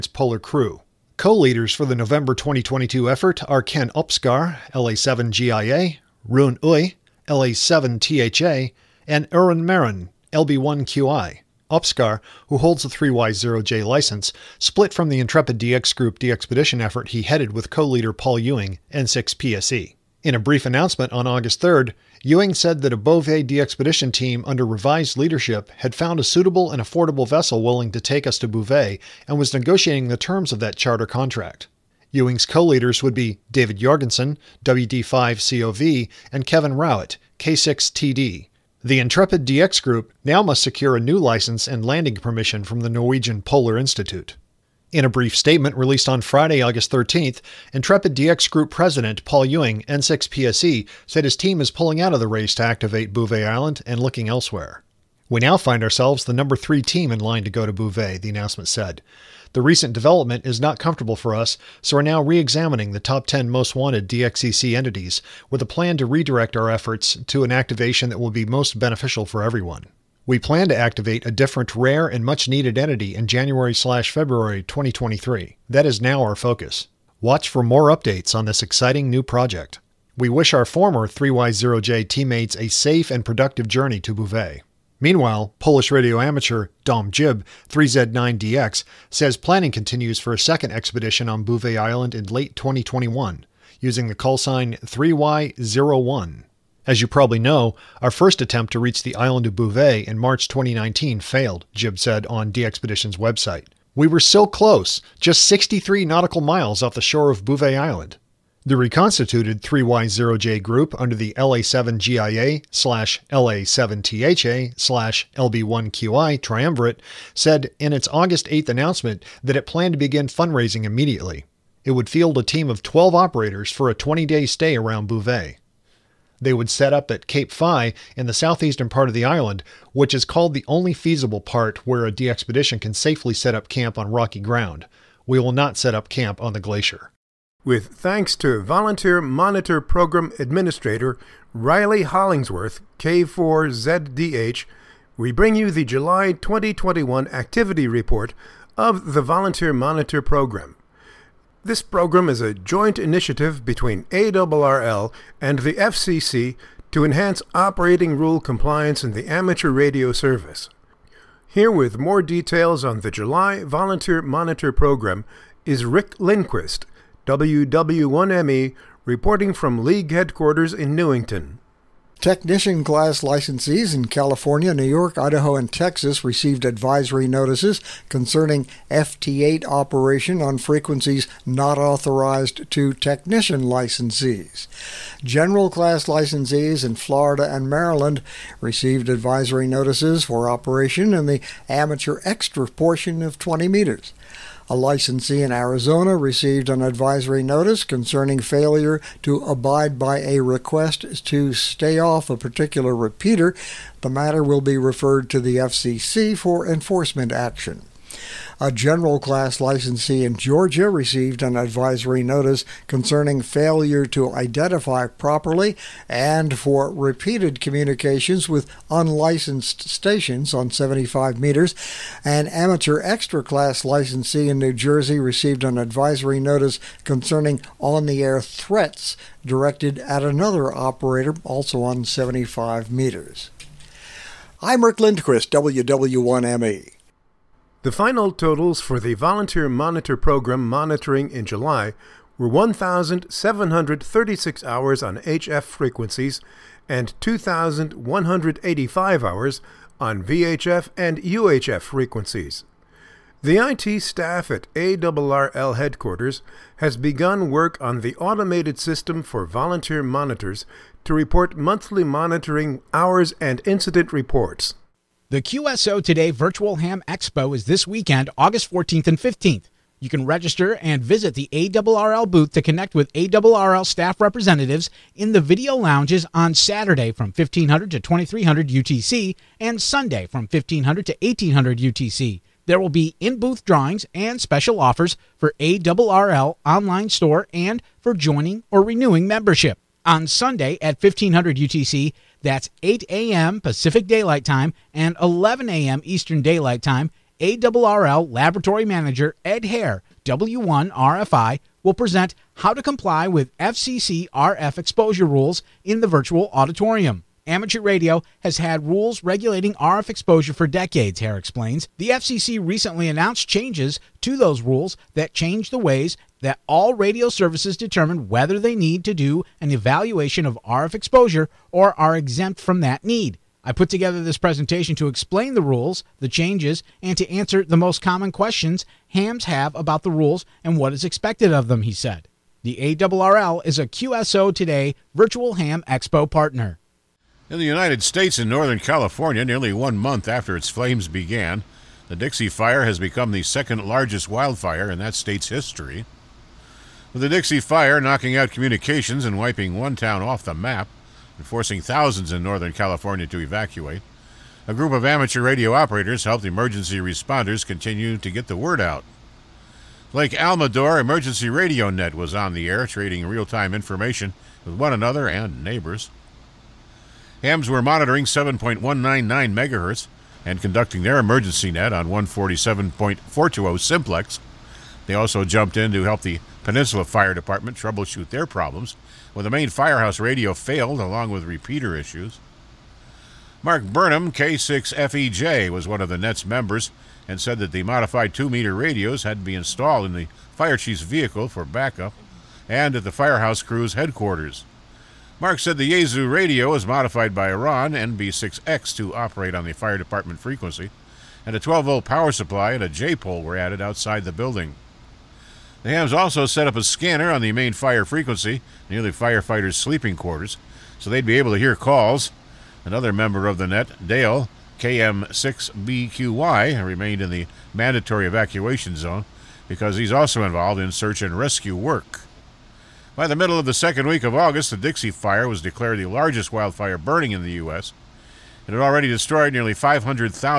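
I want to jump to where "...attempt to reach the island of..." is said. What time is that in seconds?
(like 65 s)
98 s.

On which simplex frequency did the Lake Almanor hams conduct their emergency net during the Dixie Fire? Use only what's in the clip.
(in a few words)
147.420.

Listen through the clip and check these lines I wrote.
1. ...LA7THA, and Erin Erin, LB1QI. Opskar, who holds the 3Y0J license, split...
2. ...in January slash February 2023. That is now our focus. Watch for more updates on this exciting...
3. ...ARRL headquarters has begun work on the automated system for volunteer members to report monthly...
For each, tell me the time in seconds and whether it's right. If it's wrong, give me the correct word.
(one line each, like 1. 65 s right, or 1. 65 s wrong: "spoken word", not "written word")
1. 7 s wrong: "Marin", not "Erin"
2. 73 s right
3. 254 s wrong: "monitors", not "members".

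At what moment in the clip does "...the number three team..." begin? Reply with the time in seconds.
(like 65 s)
56 s.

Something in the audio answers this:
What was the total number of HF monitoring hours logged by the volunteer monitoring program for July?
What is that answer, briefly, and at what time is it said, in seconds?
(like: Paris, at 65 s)
1,736, at 242 s.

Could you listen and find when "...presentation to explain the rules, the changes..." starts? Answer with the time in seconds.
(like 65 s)
324 s.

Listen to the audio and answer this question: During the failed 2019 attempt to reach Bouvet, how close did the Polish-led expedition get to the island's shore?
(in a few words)
63 nautical miles.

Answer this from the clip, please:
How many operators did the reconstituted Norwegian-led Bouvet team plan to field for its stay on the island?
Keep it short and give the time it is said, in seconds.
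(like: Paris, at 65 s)
12, at 122 s.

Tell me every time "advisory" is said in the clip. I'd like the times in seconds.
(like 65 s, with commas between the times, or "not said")
176 s, 189 s, 196 s, 211 s, 225 s.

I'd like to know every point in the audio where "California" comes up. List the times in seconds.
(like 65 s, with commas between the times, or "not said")
174 s, 338 s, 352 s.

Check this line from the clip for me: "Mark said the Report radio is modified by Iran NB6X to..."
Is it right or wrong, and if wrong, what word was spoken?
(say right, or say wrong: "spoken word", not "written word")
wrong: "Yaesu", not "Report".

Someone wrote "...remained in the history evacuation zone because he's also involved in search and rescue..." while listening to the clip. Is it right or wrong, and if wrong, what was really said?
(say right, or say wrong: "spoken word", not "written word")
wrong: "mandatory", not "history".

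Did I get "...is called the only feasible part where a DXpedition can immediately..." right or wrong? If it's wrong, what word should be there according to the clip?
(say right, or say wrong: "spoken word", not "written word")
wrong: "safely", not "immediately".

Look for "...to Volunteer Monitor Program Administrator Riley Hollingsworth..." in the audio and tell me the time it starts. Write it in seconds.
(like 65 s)
138 s.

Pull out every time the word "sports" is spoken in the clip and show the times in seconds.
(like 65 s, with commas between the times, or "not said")
not said.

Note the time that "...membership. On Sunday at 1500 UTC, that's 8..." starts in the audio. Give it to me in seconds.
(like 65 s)
289 s.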